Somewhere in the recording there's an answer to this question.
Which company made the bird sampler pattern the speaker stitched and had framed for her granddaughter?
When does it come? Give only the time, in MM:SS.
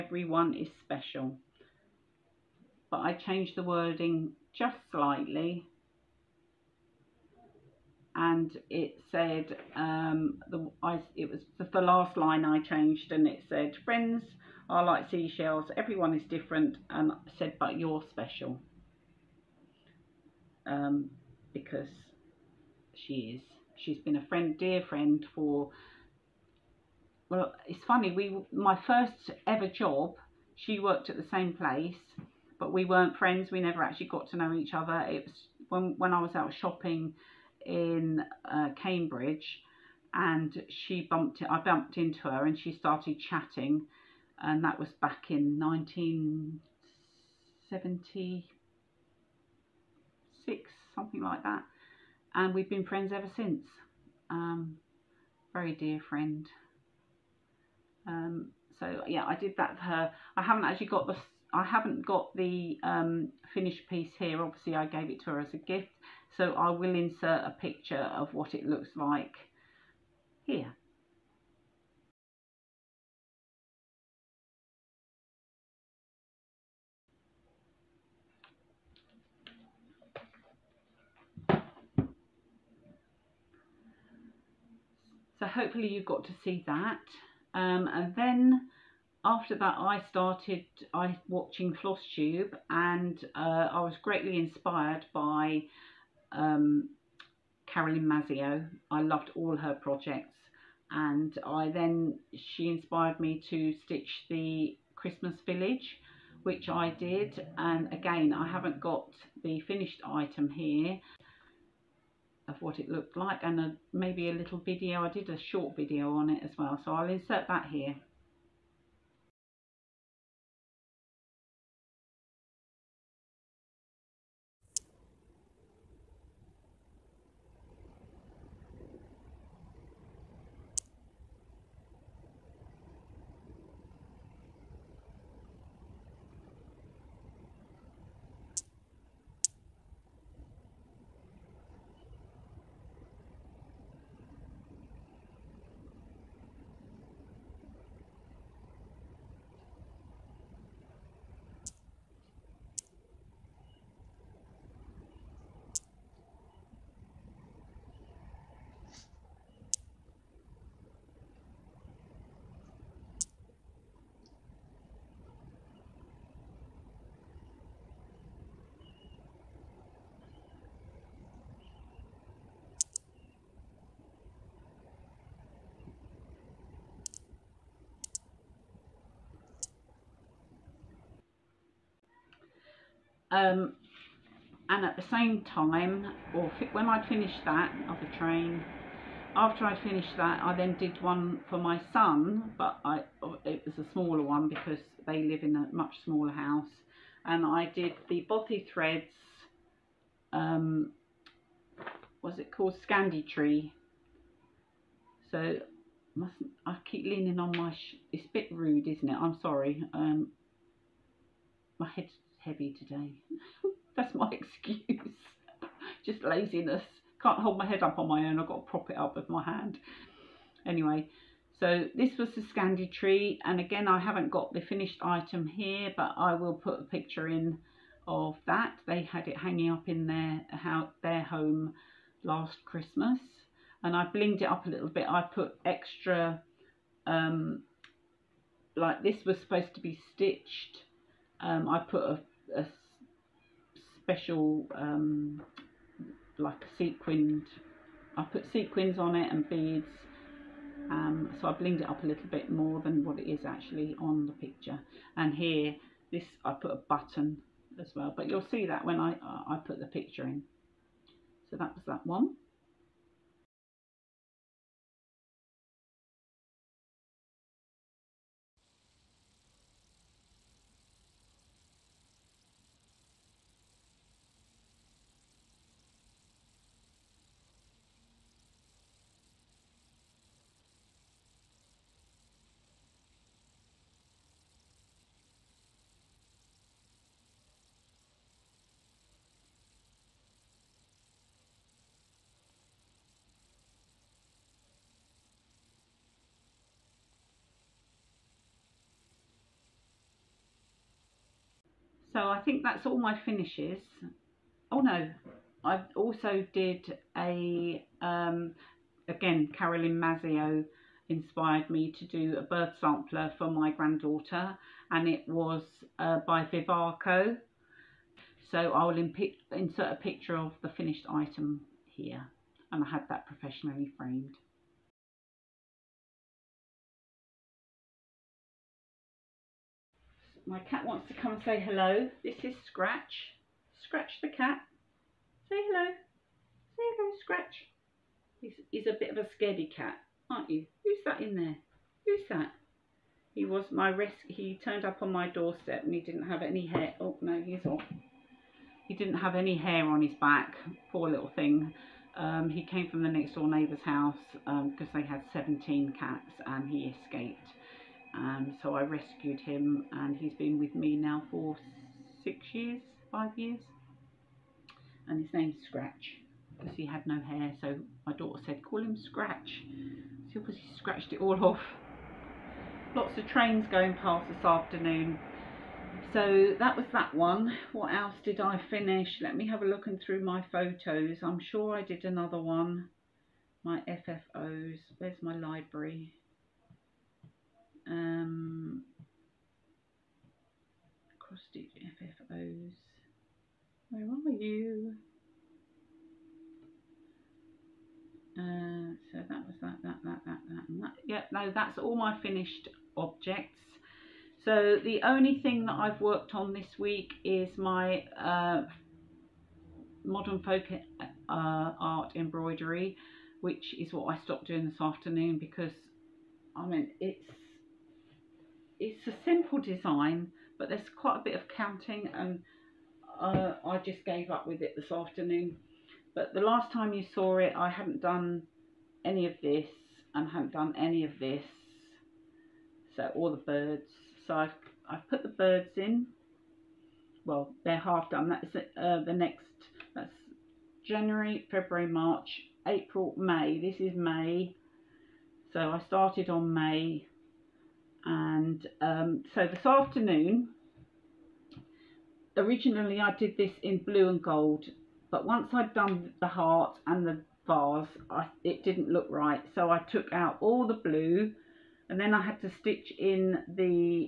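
05:16.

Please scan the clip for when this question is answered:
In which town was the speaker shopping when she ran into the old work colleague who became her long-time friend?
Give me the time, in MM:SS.
00:38.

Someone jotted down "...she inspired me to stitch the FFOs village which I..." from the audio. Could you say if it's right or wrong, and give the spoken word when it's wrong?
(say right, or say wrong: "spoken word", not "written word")
wrong: "Christmas", not "FFOs".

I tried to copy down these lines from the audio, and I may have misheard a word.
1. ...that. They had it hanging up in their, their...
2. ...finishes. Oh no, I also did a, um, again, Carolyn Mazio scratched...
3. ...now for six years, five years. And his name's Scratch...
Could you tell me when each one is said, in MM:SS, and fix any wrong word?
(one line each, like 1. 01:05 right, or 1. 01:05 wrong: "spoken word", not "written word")
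1. 03:48 right
2. 05:03 wrong: "inspired", not "scratched"
3. 06:00 right.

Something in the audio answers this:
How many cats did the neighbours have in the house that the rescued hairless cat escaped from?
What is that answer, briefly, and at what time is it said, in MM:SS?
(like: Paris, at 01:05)
17, at 05:55.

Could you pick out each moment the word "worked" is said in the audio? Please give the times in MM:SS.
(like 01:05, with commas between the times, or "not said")
00:30, 06:46.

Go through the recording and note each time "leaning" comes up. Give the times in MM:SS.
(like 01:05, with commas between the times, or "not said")
03:27.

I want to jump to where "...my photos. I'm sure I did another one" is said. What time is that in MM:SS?
06:20.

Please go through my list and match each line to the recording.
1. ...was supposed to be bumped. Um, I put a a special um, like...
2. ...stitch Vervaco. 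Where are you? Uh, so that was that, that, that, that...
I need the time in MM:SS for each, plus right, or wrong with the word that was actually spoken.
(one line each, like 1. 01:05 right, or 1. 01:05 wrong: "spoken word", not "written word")
1. 03:59 wrong: "stitched", not "bumped"
2. 06:31 wrong: "FFOs", not "Vervaco".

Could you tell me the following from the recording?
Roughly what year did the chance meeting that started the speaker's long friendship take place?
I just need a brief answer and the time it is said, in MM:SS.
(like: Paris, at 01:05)
1976, at 00:45.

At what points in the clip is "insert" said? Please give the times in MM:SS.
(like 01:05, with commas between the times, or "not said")
01:06, 01:57, 05:19.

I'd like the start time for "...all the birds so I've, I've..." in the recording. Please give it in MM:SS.
07:13.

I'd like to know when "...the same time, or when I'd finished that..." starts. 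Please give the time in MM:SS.
03:04.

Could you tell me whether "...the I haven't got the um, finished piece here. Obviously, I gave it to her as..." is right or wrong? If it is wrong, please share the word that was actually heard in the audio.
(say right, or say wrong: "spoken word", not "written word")
right.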